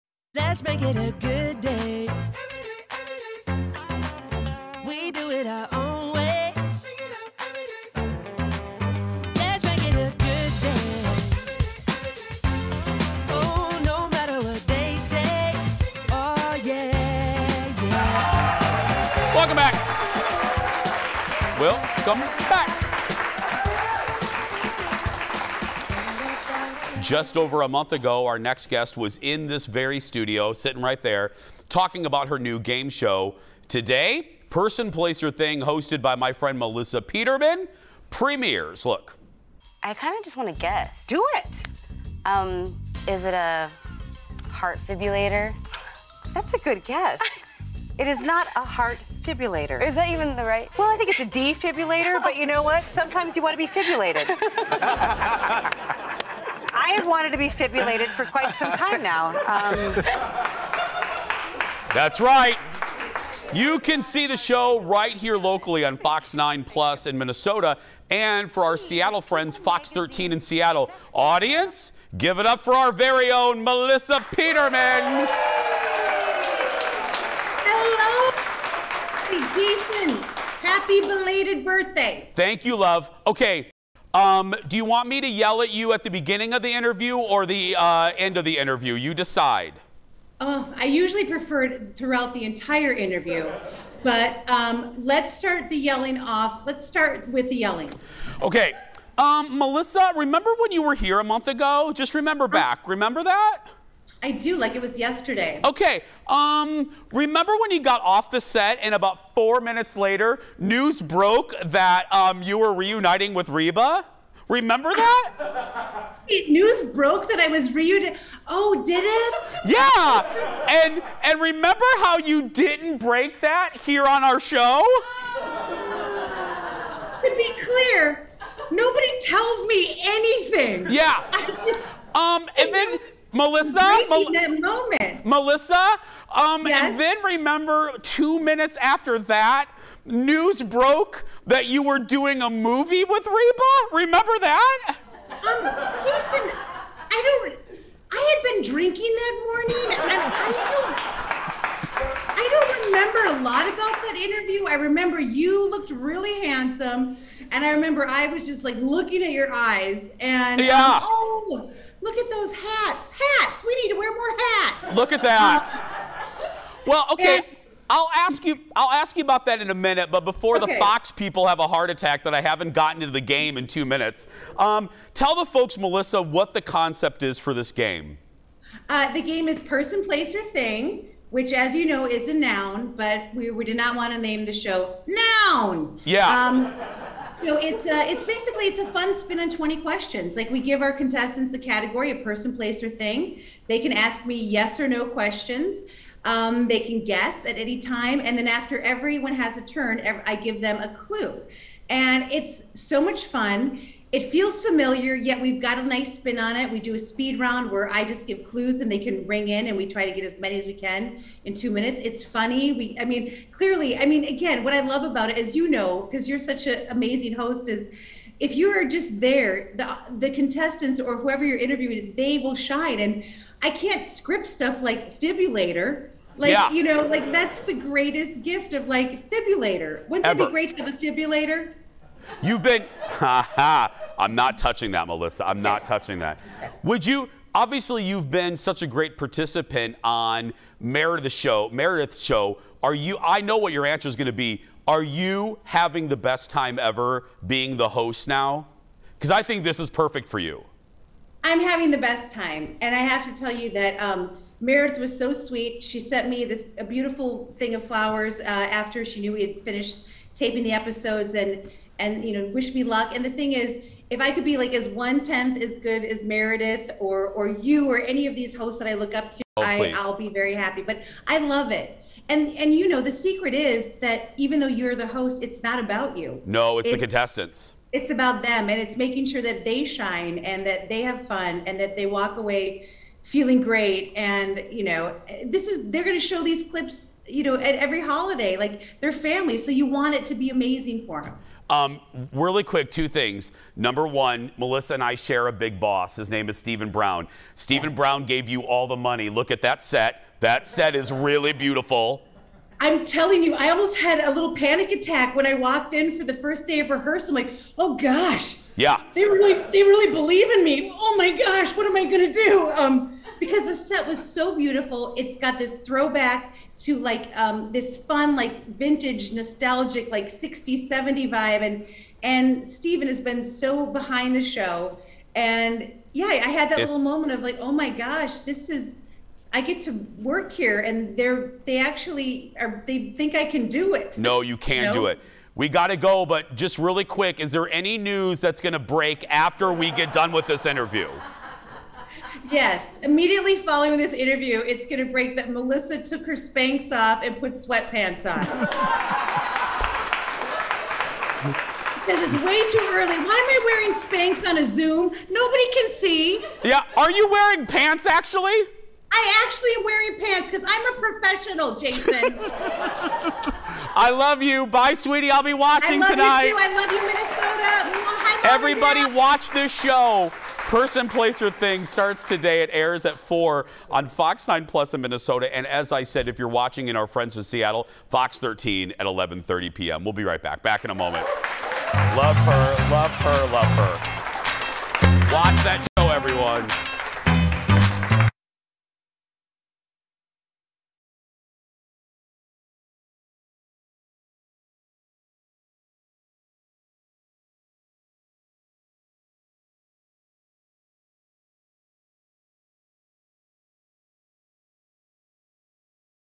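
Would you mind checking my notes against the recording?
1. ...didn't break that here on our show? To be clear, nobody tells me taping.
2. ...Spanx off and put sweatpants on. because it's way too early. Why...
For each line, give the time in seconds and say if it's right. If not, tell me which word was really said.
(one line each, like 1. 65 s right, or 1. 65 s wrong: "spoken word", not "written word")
1. 122 s wrong: "anything", not "taping"
2. 346 s right.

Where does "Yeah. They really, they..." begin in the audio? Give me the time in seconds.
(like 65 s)
308 s.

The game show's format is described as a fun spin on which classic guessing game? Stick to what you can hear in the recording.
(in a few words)
20 questions.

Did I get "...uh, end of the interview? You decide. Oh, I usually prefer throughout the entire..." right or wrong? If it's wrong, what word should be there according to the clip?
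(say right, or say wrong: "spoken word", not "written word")
right.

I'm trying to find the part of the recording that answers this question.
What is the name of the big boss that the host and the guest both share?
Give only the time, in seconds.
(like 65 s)
296 s.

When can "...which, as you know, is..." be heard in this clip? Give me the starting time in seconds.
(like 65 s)
181 s.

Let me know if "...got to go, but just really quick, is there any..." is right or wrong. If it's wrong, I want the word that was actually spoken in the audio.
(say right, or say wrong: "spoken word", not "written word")
right.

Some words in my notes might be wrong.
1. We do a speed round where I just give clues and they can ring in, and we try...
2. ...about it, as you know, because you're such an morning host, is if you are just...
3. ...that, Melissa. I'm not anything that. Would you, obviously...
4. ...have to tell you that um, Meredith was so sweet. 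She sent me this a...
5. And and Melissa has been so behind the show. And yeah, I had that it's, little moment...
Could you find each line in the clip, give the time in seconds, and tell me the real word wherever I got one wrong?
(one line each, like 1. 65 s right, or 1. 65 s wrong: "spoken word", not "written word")
1. 206 s right
2. 215 s wrong: "amazing", not "morning"
3. 234 s wrong: "touching", not "anything"
4. 252 s right
5. 321 s wrong: "Steven", not "Melissa".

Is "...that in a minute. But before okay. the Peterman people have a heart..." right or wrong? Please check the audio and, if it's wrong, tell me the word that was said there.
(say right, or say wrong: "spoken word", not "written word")
wrong: "Fox", not "Peterman".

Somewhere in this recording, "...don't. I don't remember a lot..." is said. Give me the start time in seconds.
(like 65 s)
150 s.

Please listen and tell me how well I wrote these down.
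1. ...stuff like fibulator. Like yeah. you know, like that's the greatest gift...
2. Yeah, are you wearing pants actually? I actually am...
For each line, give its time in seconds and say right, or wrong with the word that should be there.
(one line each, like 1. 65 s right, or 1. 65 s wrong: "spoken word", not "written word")
1. 224 s right
2. 356 s right.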